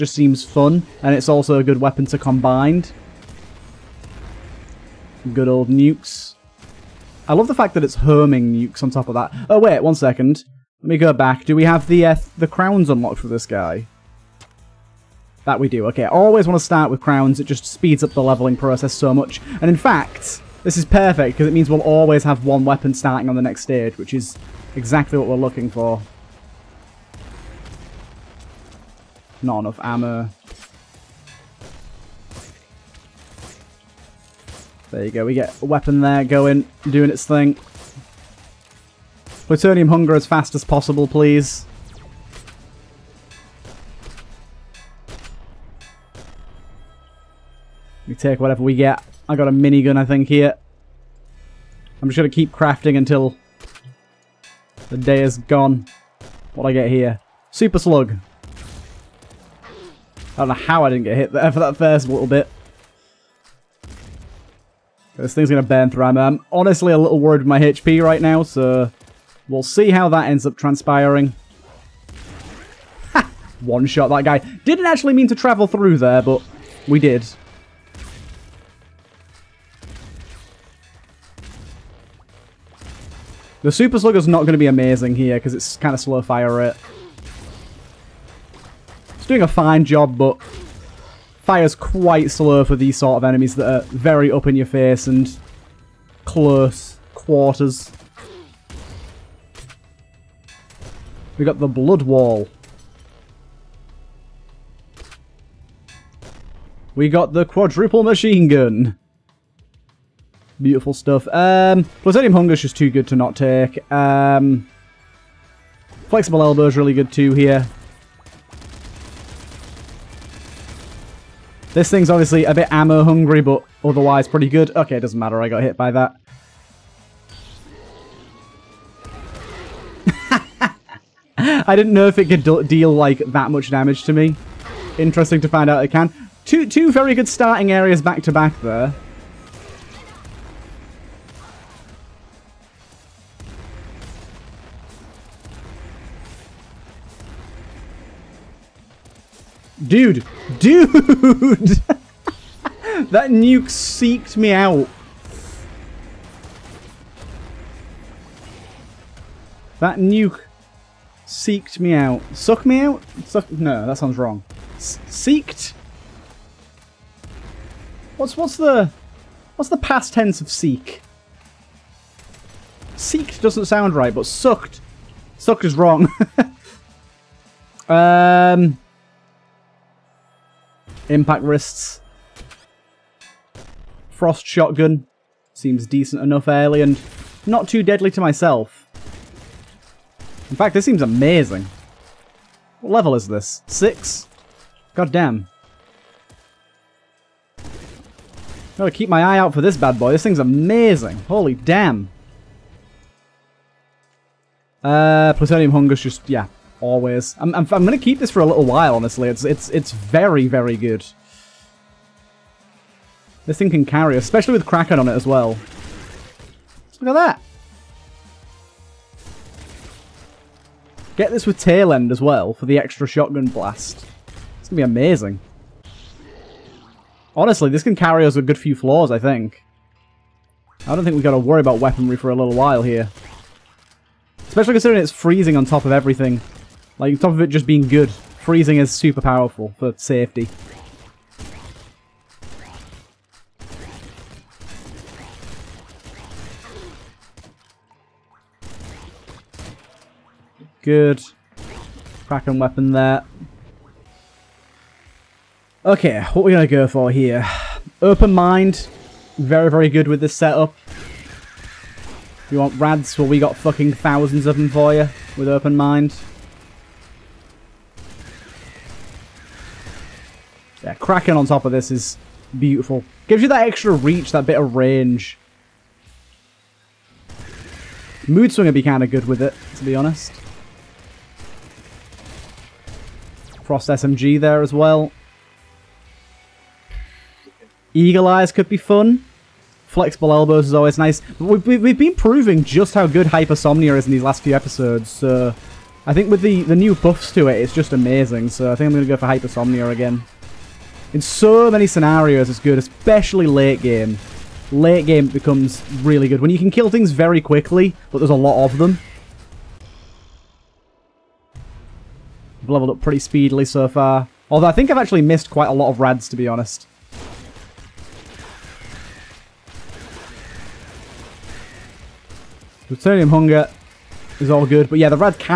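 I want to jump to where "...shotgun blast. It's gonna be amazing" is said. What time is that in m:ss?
3:43.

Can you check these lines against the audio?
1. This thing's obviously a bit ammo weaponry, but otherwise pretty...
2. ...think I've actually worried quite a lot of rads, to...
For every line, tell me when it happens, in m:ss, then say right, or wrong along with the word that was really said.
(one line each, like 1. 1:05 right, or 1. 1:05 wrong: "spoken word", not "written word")
1. 2:01 wrong: "hungry", not "weaponry"
2. 5:14 wrong: "missed", not "worried".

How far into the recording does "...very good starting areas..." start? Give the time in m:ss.
2:16.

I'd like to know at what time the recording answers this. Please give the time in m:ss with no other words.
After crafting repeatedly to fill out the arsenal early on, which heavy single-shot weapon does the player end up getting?
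0:57.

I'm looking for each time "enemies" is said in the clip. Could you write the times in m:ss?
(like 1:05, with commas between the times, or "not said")
1:33.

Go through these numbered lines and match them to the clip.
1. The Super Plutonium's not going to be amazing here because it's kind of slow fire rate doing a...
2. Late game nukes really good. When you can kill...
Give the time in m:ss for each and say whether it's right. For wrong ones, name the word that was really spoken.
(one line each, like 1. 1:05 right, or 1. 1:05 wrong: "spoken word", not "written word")
1. 1:23 wrong: "Slugger", not "Plutonium"
2. 5:04 wrong: "becomes", not "nukes".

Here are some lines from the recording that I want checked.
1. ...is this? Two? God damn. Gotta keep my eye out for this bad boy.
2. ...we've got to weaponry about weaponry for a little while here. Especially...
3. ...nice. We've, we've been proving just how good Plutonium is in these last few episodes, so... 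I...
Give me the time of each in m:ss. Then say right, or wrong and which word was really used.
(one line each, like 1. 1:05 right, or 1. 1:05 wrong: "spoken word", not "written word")
1. 3:13 wrong: "Six", not "Two"
2. 3:51 wrong: "worry", not "weaponry"
3. 4:50 wrong: "Hypersomnia", not "Plutonium".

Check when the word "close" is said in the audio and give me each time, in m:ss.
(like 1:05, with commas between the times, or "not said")
1:36.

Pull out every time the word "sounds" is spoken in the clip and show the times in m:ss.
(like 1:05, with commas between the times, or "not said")
2:43, 2:53.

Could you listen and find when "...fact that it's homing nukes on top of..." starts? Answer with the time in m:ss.
0:07.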